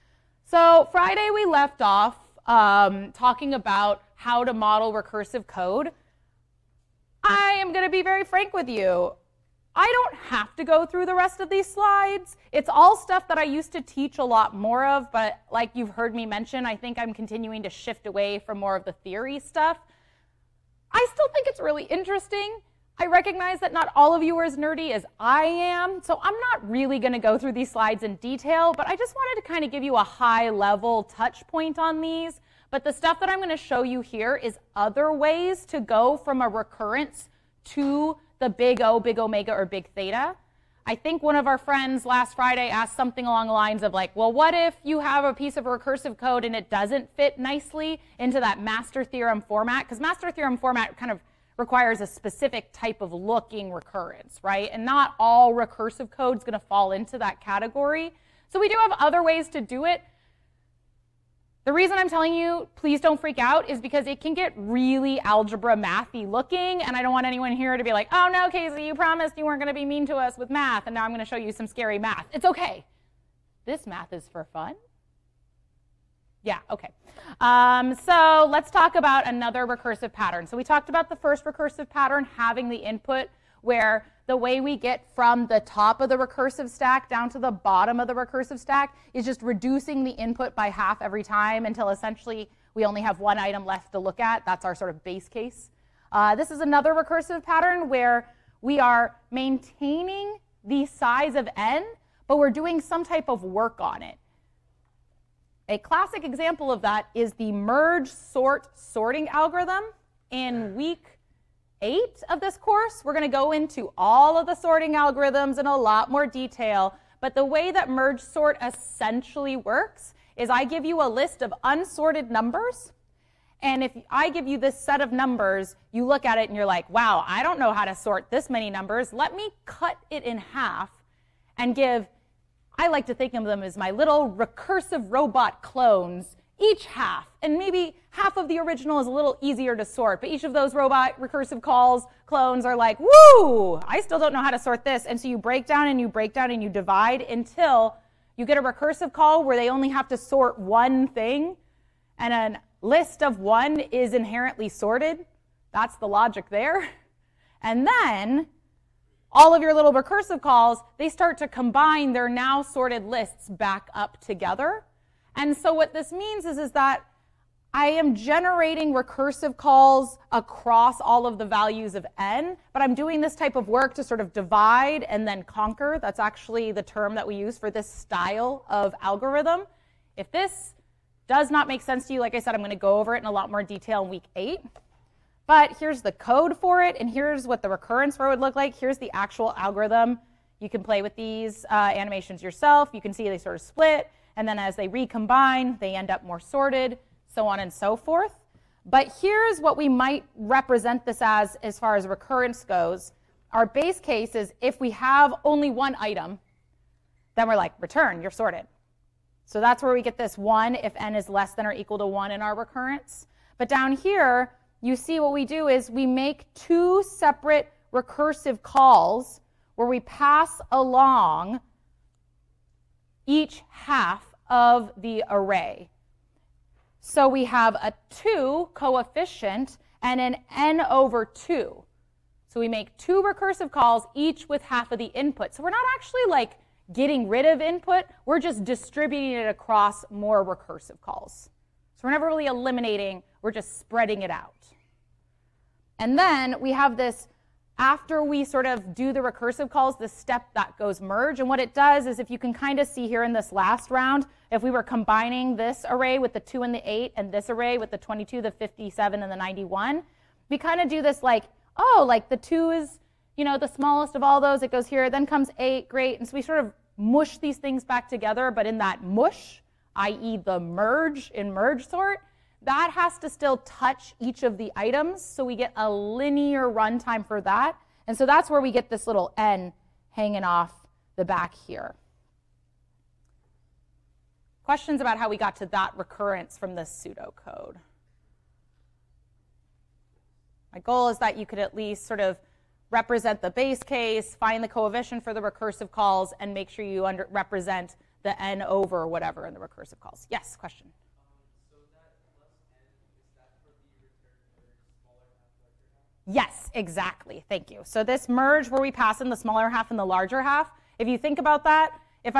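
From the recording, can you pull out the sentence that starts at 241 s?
So we're never really eliminating, we're just spreading it out.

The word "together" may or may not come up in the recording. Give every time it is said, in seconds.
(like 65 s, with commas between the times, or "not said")
164 s, 268 s.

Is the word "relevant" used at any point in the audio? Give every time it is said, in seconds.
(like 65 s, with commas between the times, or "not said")
not said.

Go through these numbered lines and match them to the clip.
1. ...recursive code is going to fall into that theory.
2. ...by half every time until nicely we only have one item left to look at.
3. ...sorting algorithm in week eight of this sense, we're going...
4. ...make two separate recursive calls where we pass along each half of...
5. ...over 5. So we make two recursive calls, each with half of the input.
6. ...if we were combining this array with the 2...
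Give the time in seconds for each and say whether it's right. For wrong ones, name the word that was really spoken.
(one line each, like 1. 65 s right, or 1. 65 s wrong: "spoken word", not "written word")
1. 55 s wrong: "category", not "theory"
2. 90 s wrong: "essentially", not "nicely"
3. 108 s wrong: "course", not "sense"
4. 216 s right
5. 230 s wrong: "2", not "5"
6. 254 s right.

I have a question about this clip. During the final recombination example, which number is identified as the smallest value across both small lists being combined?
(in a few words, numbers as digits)
2.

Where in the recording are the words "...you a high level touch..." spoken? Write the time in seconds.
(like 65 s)
29 s.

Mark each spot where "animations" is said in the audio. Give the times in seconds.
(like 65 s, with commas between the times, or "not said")
191 s.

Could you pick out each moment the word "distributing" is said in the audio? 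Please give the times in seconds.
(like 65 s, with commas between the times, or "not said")
238 s.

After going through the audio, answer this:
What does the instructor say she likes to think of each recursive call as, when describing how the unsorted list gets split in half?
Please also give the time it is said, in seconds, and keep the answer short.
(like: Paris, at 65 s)
Recursive robot clones, at 133 s.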